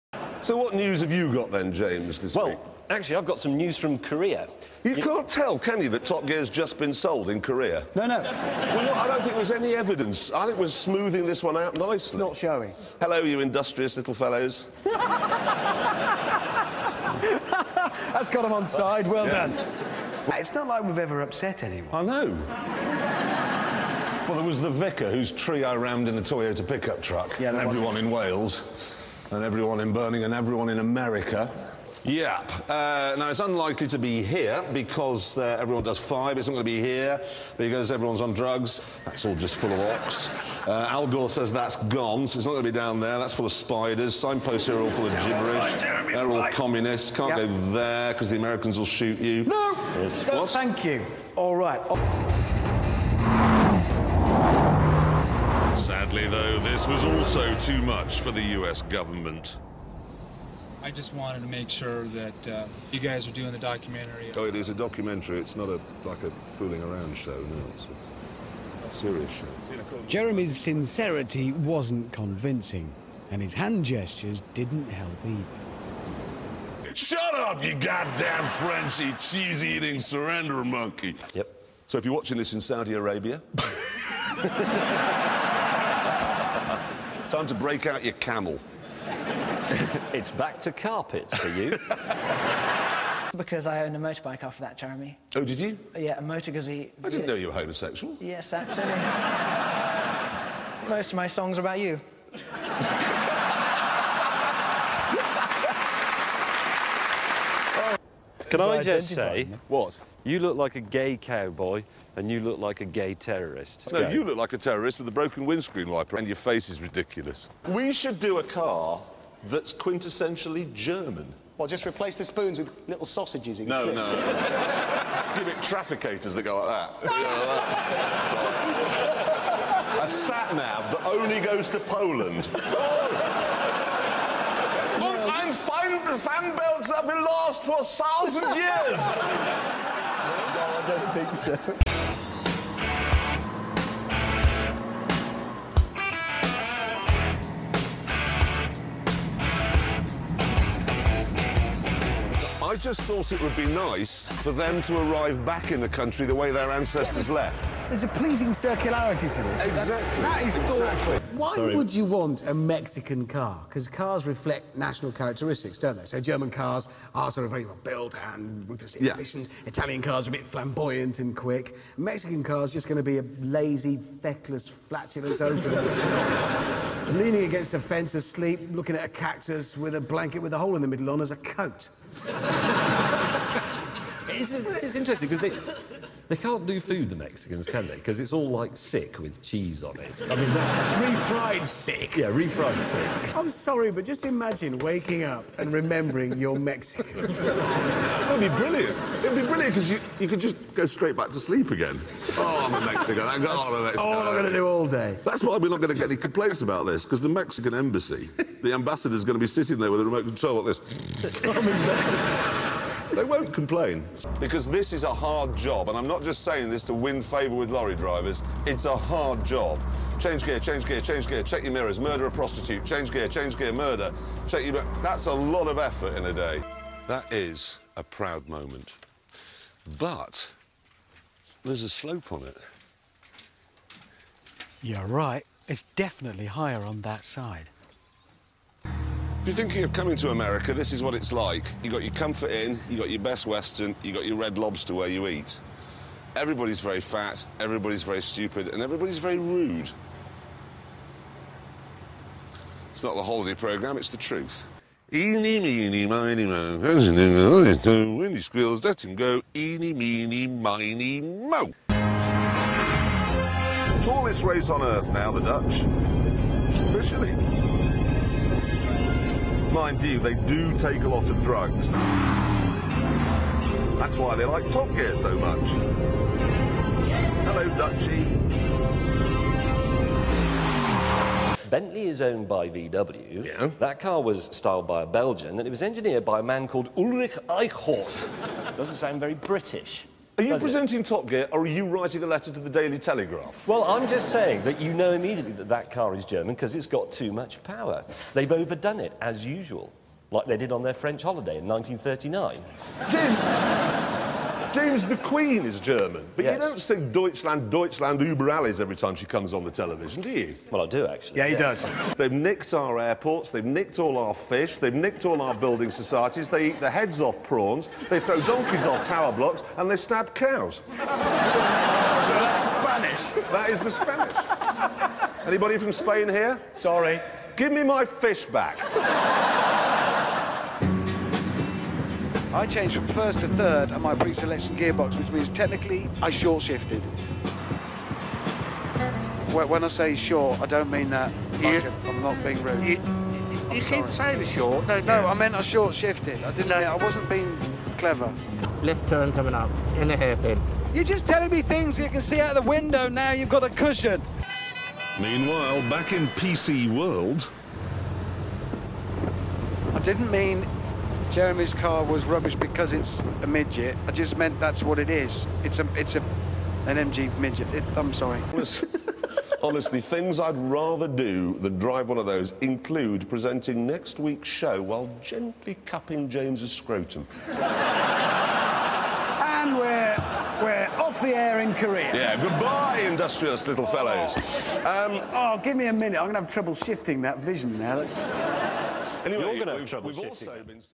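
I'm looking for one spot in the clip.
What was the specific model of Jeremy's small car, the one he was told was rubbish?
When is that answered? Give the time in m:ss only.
6:06.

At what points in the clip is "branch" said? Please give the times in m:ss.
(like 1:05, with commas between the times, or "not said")
not said.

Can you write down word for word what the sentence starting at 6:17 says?
and we're, we're off the air in Korea.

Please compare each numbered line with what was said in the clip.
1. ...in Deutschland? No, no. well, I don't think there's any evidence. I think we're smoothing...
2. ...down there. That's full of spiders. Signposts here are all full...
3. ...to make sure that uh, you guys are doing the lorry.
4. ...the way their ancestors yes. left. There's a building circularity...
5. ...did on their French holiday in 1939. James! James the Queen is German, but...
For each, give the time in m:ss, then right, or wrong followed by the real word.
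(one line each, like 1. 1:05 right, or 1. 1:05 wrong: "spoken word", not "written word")
1. 0:07 wrong: "Korea", not "Deutschland"
2. 0:42 right
3. 1:01 wrong: "documentary", not "lorry"
4. 2:36 wrong: "pleasing", not "building"
5. 5:00 right.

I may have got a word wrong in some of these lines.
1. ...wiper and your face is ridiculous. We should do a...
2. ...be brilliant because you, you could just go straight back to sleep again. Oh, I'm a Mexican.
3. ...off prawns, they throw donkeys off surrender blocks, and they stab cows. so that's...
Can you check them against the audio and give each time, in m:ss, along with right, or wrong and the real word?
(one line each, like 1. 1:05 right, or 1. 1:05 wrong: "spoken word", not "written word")
1. 1:55 right
2. 3:19 right
3. 5:17 wrong: "tower", not "surrender".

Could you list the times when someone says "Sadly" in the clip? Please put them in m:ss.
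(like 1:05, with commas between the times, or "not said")
0:55.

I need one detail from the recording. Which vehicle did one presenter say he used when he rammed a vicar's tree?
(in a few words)
Toyota pickup truck.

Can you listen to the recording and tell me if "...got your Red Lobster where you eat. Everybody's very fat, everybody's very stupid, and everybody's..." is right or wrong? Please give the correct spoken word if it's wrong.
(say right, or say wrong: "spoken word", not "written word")
right.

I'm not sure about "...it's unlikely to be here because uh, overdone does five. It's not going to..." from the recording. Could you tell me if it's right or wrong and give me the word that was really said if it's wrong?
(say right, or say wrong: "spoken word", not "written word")
wrong: "everyone", not "overdone".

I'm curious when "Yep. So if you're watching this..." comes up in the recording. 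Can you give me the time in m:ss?
1:21.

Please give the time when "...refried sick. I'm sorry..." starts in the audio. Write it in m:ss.
3:12.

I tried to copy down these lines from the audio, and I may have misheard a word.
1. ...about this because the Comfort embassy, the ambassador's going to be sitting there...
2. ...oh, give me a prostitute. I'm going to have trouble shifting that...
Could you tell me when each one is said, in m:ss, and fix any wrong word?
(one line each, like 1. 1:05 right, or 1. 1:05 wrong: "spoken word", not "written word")
1. 3:26 wrong: "Mexican", not "Comfort"
2. 6:25 wrong: "minute", not "prostitute".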